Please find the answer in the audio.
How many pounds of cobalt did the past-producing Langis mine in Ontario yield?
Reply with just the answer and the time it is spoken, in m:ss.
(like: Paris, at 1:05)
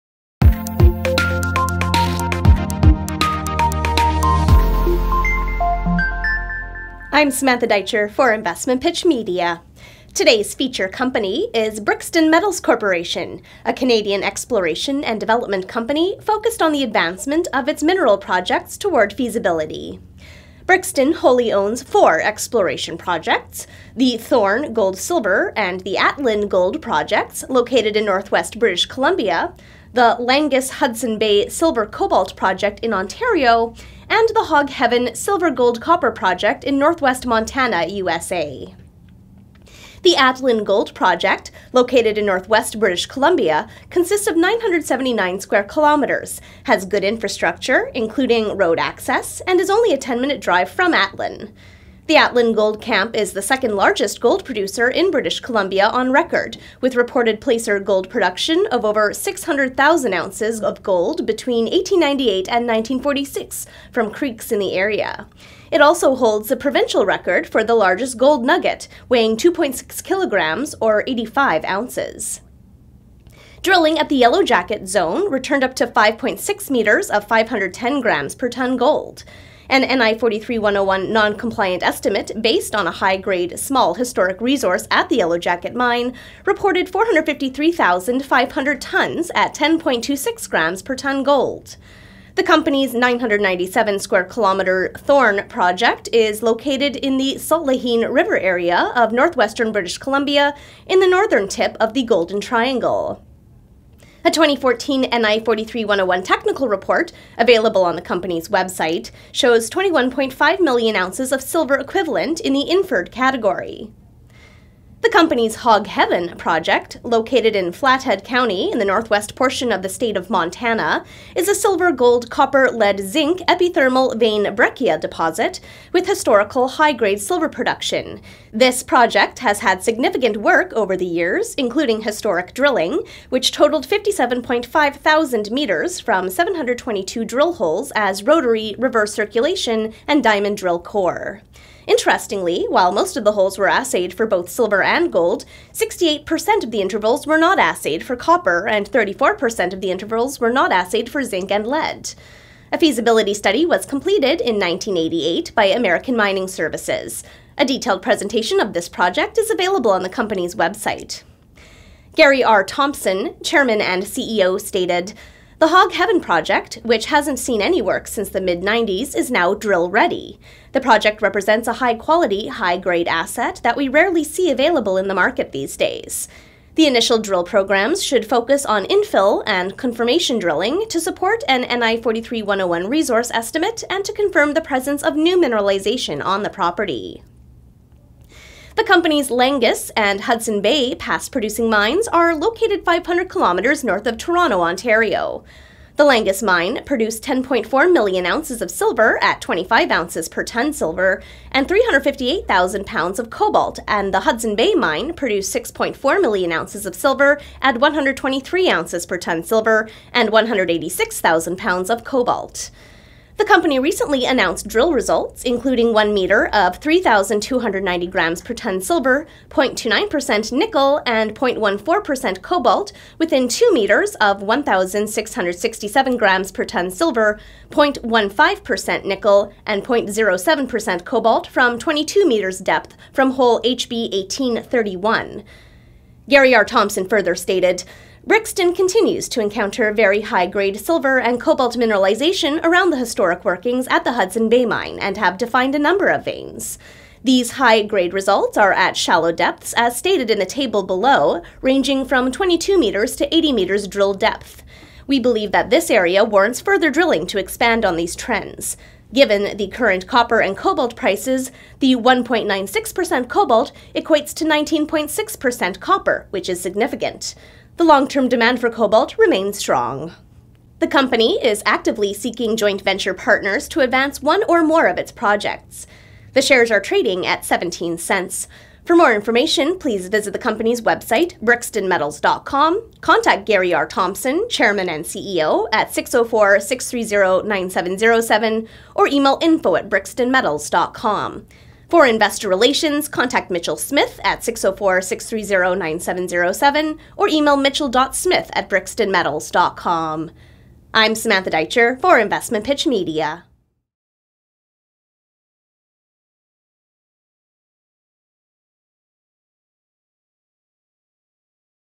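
358,000 pounds, at 3:21.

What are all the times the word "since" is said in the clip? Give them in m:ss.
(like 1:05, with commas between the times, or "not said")
2:48.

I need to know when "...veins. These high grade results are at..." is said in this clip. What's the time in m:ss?
4:06.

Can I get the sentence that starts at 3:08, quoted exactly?
The company's Langis and Hudson Bay past producing mines are located 500 kilometers north of Toronto, Ontario.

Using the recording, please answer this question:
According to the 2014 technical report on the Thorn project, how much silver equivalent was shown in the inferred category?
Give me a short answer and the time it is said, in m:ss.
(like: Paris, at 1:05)
21.5 million ounces, at 1:49.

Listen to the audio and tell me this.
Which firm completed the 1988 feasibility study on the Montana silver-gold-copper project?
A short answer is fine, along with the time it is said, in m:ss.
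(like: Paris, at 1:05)
American Mining Services, at 2:35.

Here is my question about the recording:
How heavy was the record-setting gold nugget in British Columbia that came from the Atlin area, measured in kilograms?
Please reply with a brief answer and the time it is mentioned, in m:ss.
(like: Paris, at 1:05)
2.6 kilograms, at 1:09.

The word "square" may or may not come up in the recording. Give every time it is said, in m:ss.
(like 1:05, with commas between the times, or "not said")
0:45, 1:33.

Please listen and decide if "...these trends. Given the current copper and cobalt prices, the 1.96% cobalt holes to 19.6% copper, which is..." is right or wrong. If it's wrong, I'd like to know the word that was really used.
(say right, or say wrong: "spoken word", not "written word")
wrong: "equates", not "holes".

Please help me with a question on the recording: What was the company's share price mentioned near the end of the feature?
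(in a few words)
17 cents.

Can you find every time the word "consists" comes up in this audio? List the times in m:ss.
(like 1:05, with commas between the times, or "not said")
0:43.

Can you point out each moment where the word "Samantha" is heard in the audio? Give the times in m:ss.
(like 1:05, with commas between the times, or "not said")
0:07, 5:01.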